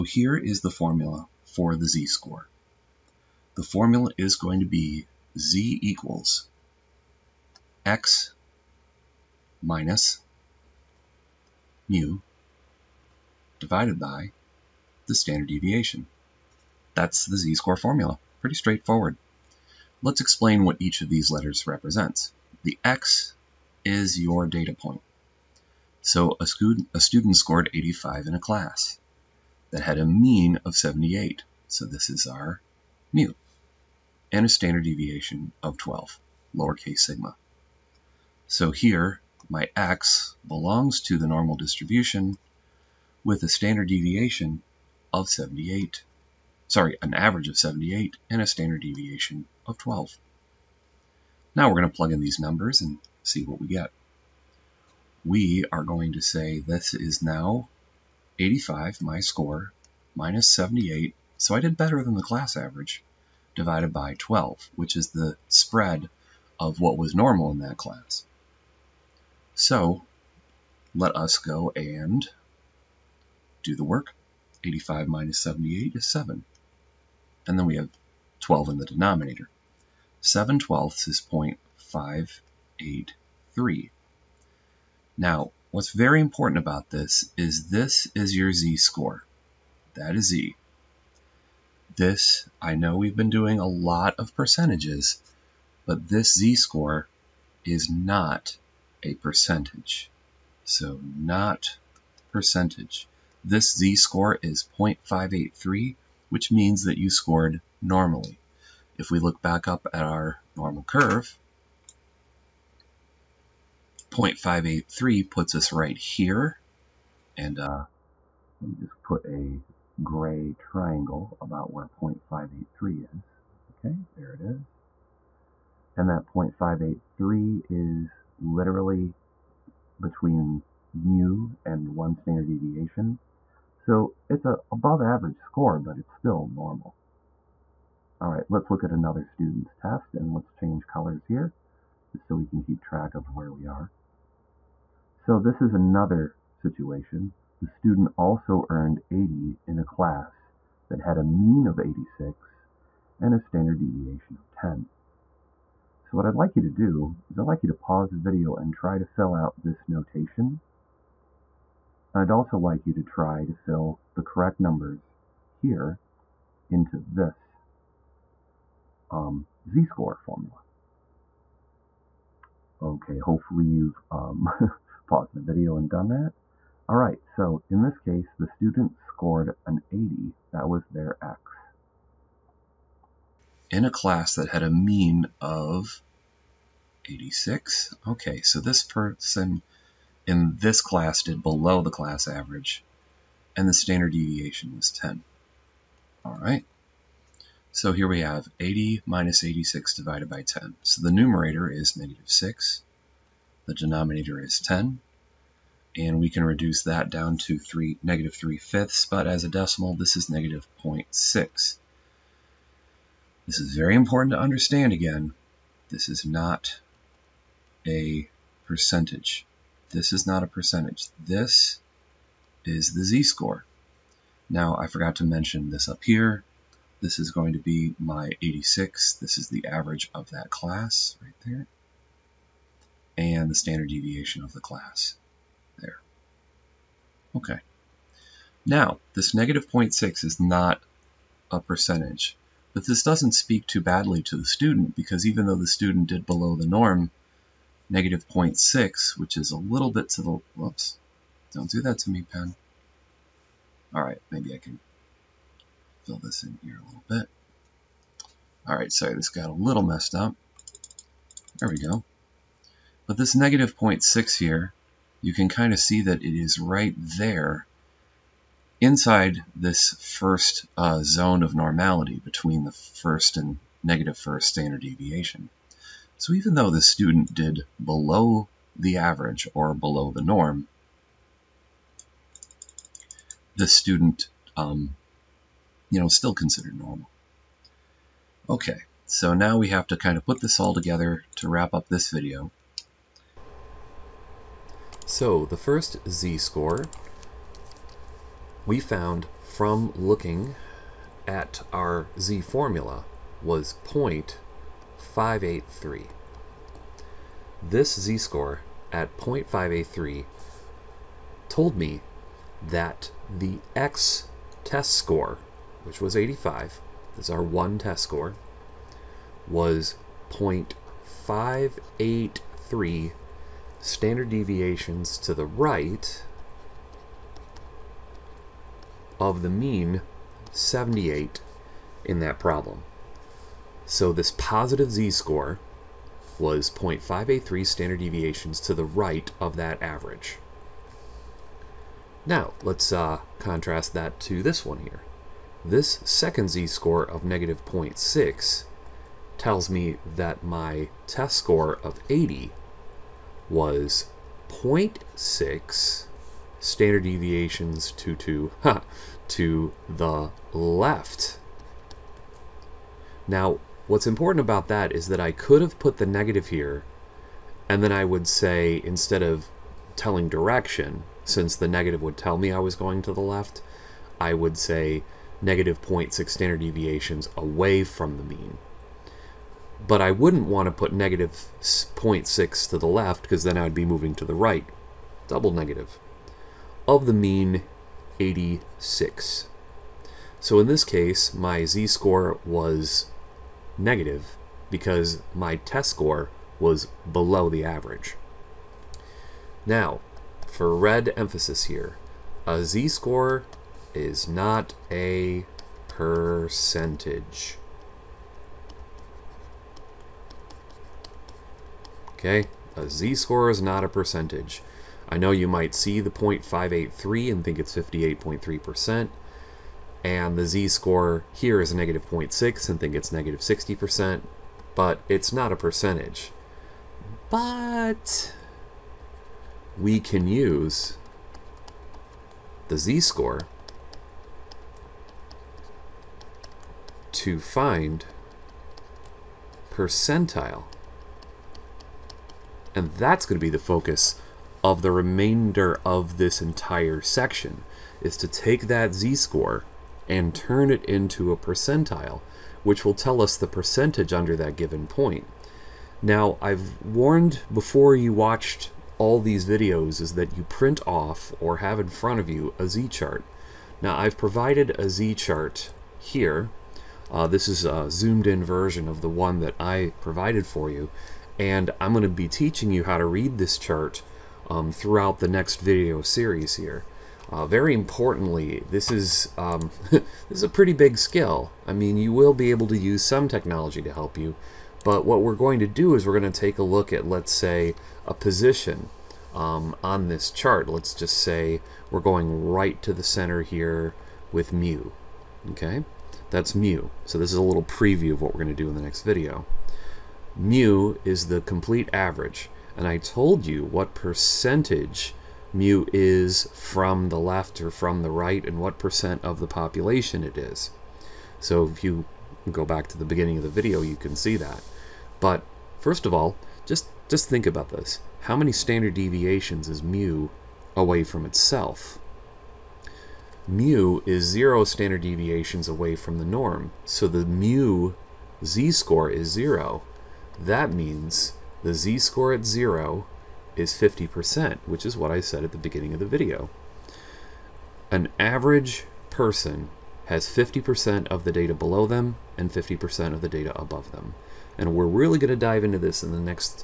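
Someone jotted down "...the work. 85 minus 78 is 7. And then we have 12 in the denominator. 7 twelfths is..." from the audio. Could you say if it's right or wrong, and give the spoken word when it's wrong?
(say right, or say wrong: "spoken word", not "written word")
right.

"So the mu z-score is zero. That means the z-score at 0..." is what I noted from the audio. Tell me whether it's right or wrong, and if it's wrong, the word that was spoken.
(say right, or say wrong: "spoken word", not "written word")
right.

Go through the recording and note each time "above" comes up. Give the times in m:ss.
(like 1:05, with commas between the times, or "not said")
2:14, 9:03.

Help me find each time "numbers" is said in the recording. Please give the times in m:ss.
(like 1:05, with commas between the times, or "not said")
0:52, 2:44.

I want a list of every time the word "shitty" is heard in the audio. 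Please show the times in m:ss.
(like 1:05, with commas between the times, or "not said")
not said.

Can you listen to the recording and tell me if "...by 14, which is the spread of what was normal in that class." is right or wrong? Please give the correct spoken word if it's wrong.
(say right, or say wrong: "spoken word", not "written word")
wrong: "12", not "14".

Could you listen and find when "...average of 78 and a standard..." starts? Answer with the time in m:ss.
0:47.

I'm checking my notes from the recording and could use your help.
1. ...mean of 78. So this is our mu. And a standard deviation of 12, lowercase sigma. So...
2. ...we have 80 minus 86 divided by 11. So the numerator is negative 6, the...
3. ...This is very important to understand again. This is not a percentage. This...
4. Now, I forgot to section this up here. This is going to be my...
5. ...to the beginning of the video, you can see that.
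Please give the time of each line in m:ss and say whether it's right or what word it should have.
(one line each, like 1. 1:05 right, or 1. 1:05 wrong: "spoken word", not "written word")
1. 0:30 right
2. 3:18 wrong: "10", not "11"
3. 3:33 right
4. 3:44 wrong: "mention", not "section"
5. 8:32 right.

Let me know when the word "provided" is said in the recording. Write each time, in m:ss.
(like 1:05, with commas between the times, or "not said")
7:44, 7:50.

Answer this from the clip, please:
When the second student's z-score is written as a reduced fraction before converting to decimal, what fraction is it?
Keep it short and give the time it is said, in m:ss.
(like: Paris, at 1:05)
negative 3/5, at 3:28.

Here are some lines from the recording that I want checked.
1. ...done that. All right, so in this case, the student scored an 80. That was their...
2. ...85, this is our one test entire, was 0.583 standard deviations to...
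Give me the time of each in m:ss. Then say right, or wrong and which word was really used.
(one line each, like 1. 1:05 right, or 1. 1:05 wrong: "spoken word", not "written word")
1. 2:55 right
2. 5:16 wrong: "score", not "entire".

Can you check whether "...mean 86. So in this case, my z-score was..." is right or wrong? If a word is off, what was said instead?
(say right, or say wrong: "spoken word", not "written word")
right.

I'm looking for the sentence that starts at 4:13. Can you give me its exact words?
All right, maybe I can fill this in here a little bit.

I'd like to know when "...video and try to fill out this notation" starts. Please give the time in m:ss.
2:38.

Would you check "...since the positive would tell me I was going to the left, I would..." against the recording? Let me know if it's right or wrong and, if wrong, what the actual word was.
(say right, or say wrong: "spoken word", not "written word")
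wrong: "negative", not "positive".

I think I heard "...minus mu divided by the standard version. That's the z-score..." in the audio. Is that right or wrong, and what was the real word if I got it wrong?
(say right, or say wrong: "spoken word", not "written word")
wrong: "deviation", not "version".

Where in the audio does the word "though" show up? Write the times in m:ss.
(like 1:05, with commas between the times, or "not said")
4:05, 4:36.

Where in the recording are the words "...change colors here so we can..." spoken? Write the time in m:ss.
2:20.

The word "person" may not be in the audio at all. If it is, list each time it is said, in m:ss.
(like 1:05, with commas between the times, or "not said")
3:08, 8:59.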